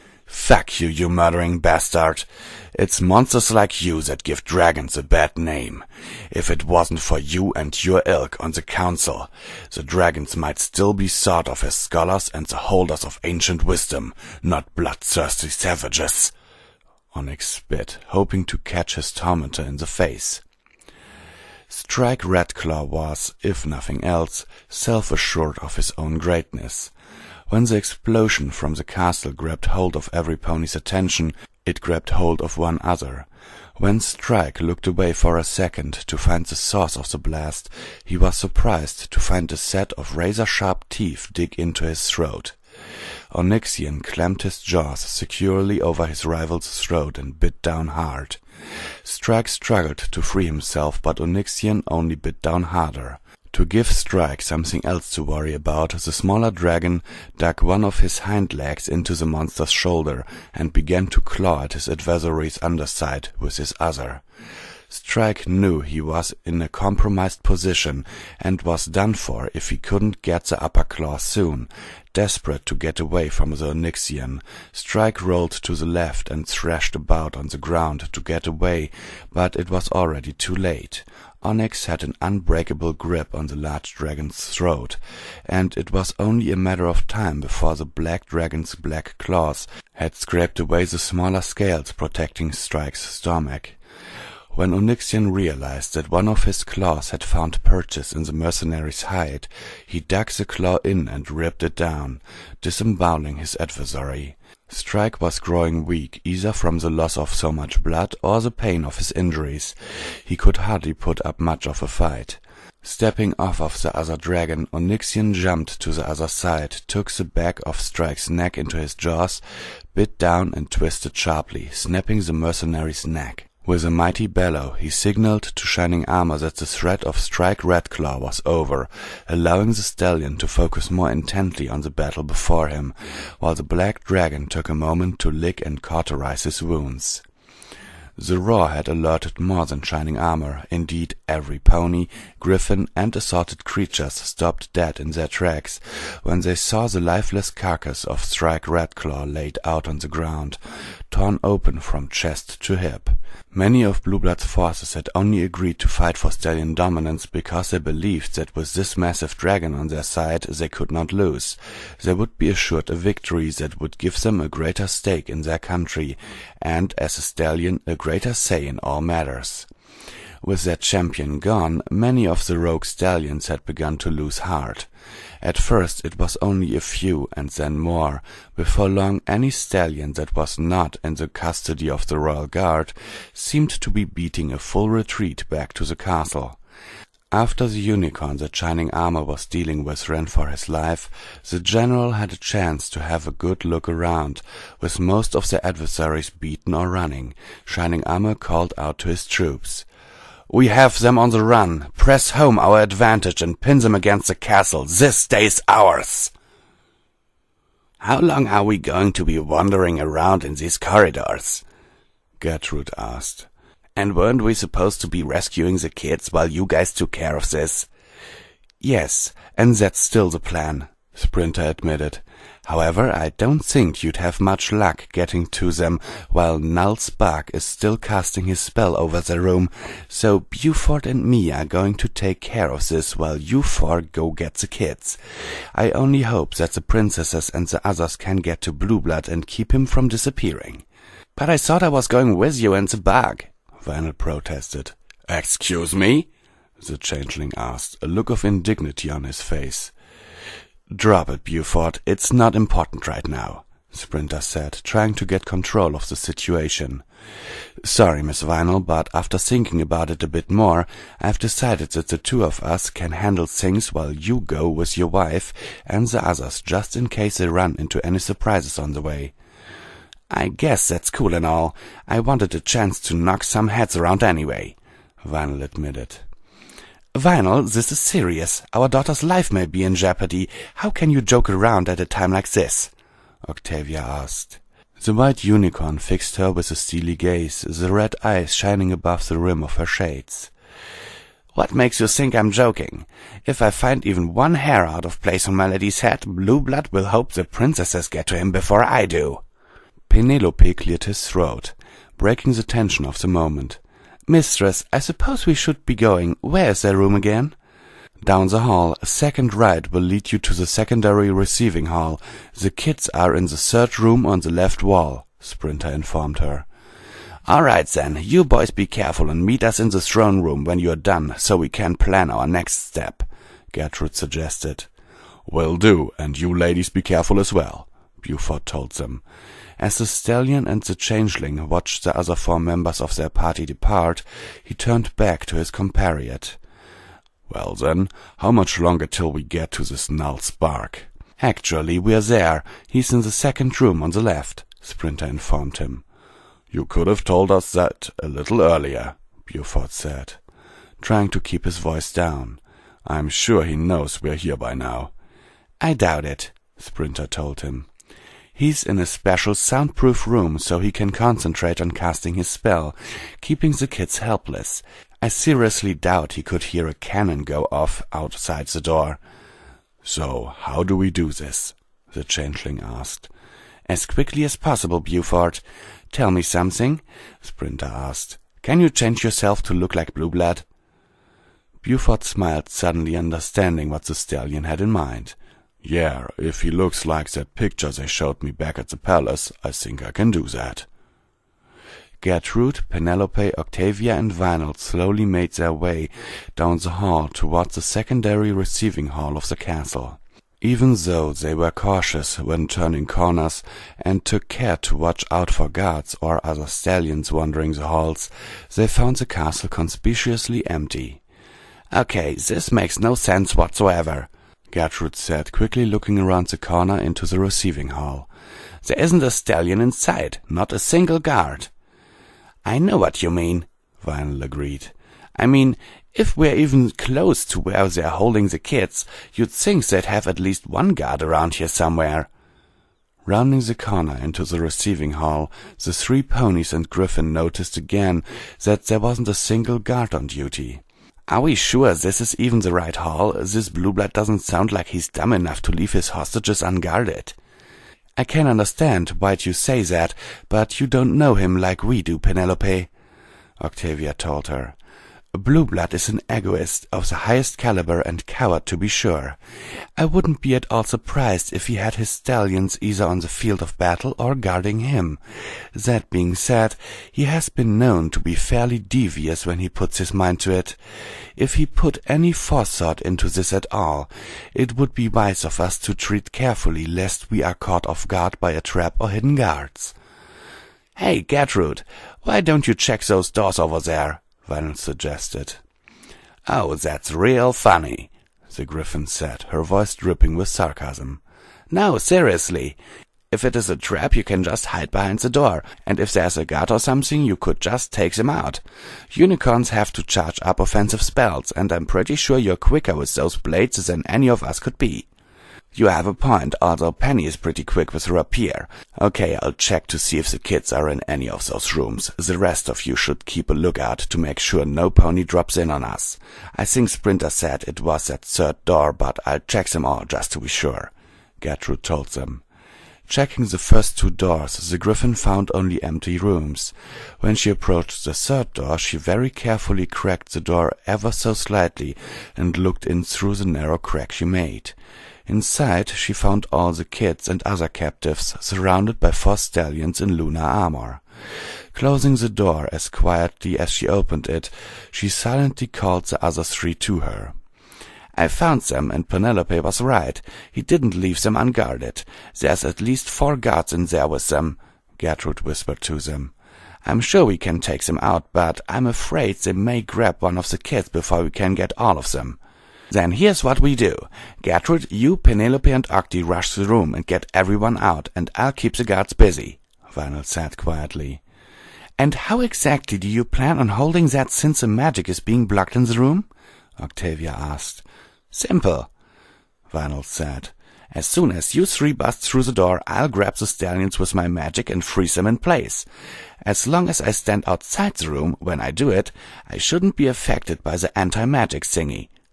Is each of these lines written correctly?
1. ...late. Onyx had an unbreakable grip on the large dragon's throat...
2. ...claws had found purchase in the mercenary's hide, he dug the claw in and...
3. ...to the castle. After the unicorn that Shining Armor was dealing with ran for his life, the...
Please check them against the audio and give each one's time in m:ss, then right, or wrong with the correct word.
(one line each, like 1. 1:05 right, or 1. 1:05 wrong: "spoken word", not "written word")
1. 1:20 right
2. 1:36 right
3. 3:05 right.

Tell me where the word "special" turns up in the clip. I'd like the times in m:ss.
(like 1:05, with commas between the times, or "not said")
5:59.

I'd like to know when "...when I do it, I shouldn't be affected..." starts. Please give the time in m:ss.
9:48.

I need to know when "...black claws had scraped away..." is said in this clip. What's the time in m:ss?
1:28.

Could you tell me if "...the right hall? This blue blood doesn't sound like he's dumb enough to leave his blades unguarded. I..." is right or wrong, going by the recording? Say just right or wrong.
wrong.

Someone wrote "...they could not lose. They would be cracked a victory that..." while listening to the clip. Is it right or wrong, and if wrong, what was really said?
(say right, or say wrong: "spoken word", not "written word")
wrong: "assured", not "cracked".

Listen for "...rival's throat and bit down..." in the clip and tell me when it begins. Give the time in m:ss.
0:46.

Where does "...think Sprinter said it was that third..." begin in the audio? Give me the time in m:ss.
8:36.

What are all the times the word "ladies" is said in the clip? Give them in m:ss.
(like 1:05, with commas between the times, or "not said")
5:26.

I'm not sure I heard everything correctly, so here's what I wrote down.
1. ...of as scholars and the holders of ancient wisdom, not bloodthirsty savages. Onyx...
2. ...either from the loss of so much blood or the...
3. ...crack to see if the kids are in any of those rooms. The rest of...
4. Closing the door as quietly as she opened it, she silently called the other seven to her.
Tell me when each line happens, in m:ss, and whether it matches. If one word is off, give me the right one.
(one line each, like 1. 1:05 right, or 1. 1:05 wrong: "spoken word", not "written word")
1. 0:11 right
2. 1:46 right
3. 8:29 wrong: "check", not "crack"
4. 9:01 wrong: "three", not "seven".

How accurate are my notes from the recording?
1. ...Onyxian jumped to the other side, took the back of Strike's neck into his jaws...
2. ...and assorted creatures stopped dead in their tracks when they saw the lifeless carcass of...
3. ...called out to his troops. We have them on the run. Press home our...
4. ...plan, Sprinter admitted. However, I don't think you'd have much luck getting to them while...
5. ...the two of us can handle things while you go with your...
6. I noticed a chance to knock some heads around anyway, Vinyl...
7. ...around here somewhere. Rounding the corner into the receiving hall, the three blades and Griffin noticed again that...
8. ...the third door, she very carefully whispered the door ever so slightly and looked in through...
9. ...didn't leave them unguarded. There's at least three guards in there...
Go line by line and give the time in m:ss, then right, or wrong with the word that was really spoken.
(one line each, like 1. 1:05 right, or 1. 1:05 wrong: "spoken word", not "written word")
1. 1:54 right
2. 2:22 right
3. 3:18 right
4. 3:40 right
5. 4:22 right
6. 4:32 wrong: "wanted", not "noticed"
7. 7:11 wrong: "ponies", not "blades"
8. 8:48 wrong: "cracked", not "whispered"
9. 9:10 wrong: "four", not "three".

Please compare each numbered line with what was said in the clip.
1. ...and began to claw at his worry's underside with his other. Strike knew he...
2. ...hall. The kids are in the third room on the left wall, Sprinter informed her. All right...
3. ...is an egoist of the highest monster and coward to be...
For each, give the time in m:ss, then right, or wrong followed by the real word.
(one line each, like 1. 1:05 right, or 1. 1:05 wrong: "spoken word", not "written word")
1. 1:00 wrong: "adversary", not "worry"
2. 5:11 right
3. 7:35 wrong: "caliber", not "monster".